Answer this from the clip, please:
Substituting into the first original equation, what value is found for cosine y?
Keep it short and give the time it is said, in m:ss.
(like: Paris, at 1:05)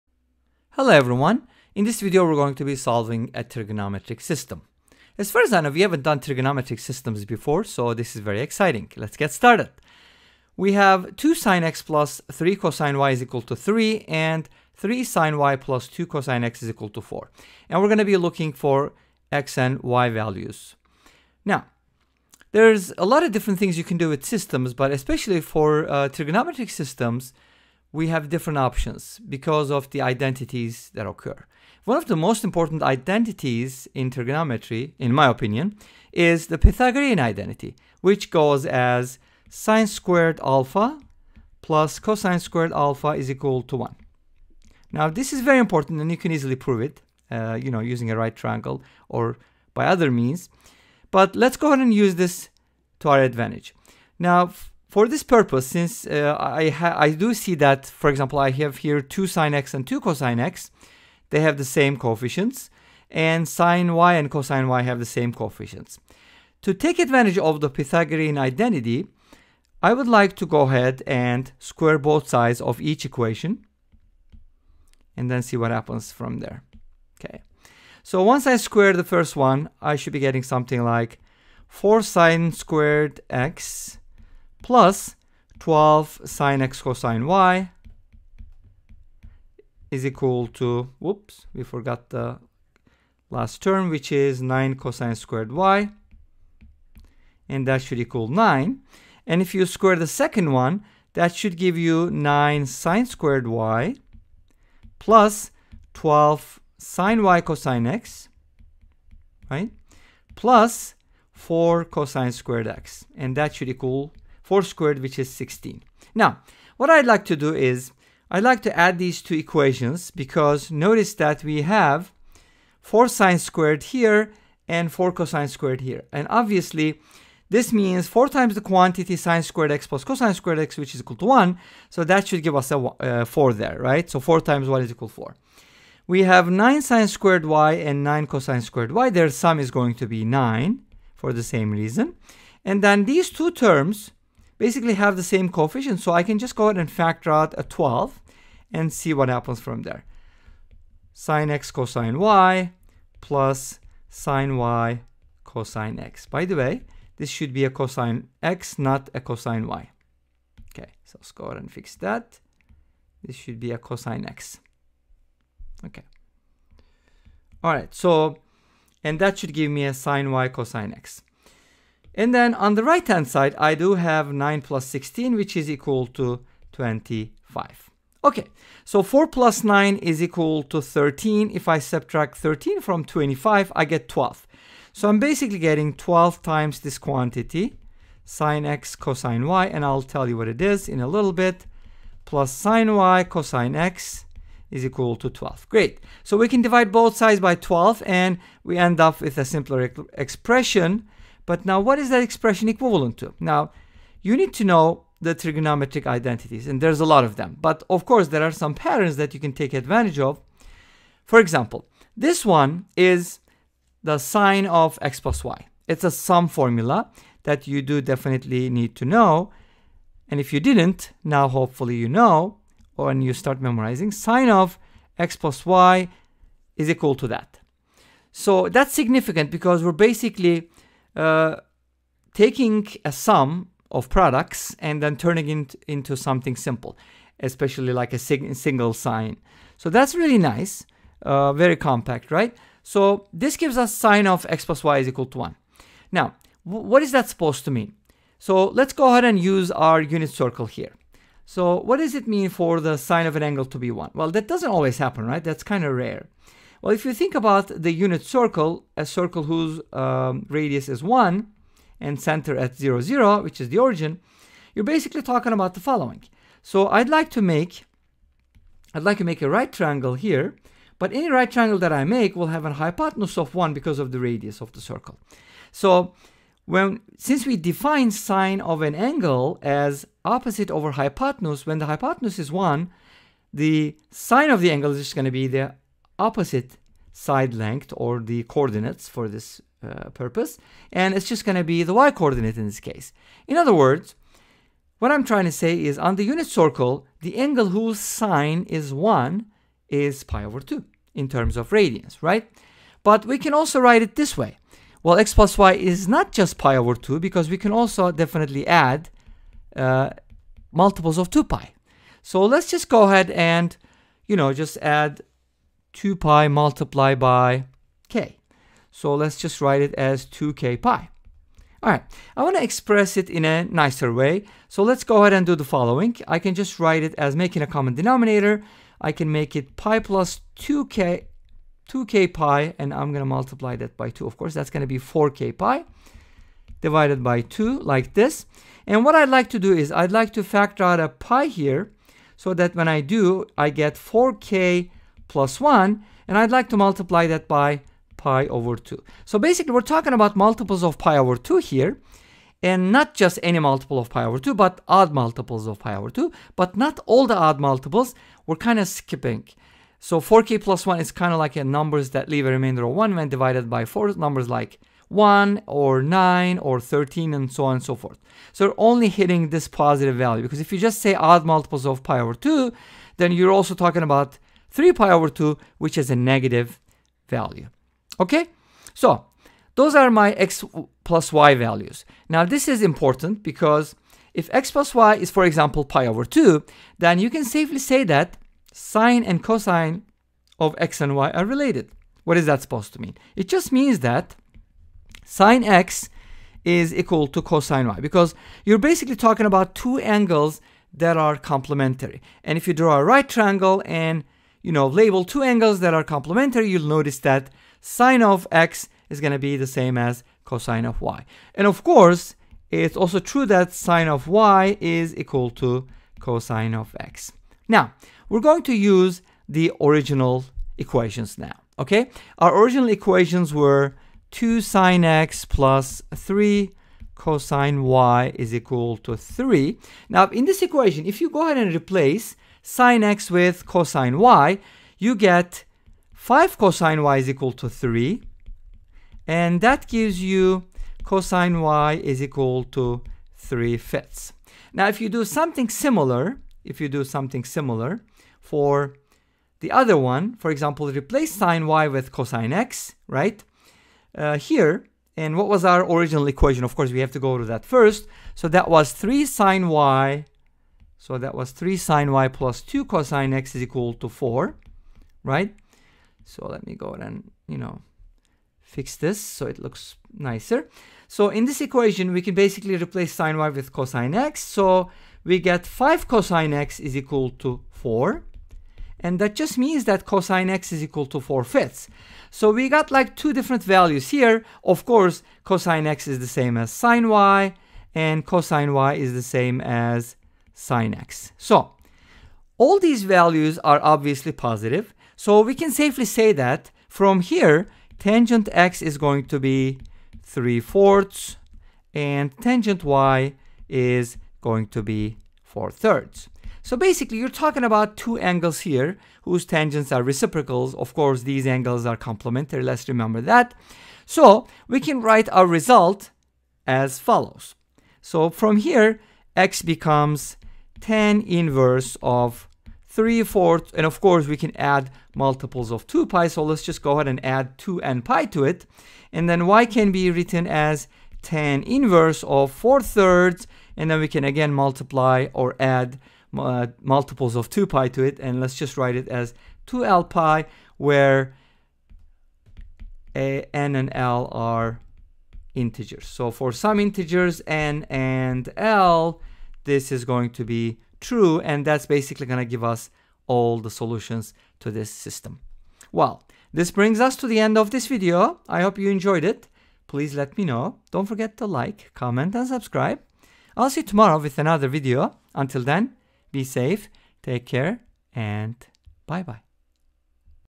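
3/5, at 7:23.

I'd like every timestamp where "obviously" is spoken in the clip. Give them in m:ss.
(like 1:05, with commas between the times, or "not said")
2:06, 8:13.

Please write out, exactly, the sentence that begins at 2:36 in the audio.
By the way, this should be a cosine x, not a cosine y.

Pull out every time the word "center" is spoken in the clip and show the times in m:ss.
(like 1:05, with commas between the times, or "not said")
4:22.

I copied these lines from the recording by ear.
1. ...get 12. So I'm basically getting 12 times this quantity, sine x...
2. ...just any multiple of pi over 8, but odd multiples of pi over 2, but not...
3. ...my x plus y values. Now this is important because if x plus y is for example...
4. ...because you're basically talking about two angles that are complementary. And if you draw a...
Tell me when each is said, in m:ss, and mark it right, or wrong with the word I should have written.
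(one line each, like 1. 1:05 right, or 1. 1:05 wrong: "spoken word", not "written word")
1. 3:03 right
2. 5:53 wrong: "2", not "8"
3. 6:20 right
4. 6:37 right.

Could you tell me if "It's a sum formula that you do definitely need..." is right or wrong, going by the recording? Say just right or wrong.
right.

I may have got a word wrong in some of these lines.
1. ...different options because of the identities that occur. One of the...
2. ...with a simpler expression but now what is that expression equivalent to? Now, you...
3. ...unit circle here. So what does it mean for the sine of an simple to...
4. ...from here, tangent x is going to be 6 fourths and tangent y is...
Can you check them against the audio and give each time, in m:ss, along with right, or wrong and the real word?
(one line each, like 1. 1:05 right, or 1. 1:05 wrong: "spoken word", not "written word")
1. 0:28 right
2. 3:19 right
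3. 4:10 wrong: "angle", not "simple"
4. 8:16 wrong: "3", not "6".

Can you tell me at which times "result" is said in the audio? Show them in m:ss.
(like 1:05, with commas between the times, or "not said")
8:35.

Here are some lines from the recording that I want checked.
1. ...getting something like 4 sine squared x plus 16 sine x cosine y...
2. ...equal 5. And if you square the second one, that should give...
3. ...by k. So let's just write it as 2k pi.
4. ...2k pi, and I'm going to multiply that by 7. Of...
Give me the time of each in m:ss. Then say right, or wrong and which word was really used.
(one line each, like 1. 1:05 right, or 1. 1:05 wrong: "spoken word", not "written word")
1. 1:20 wrong: "12", not "16"
2. 1:37 wrong: "9", not "5"
3. 5:17 right
4. 5:31 wrong: "2", not "7".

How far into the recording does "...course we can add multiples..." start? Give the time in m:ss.
8:44.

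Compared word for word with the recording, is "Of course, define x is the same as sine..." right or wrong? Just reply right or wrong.
wrong.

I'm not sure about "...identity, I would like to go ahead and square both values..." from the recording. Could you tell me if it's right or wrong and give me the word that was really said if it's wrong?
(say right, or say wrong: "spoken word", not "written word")
wrong: "sides", not "values".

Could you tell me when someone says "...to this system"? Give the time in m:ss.
9:14.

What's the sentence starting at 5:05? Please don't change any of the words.
Well, x plus y is not just pi over 2 because we can also definitely add uh, multiples of 2 pi.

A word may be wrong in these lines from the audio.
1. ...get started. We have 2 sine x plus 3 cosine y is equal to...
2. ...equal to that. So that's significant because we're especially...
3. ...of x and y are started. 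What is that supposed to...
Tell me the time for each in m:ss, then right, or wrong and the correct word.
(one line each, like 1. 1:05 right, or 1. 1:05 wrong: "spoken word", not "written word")
1. 0:09 right
2. 3:46 wrong: "basically", not "especially"
3. 6:30 wrong: "related", not "started".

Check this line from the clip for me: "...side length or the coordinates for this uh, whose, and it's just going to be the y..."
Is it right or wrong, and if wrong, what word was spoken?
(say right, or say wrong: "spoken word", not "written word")
wrong: "purpose", not "whose".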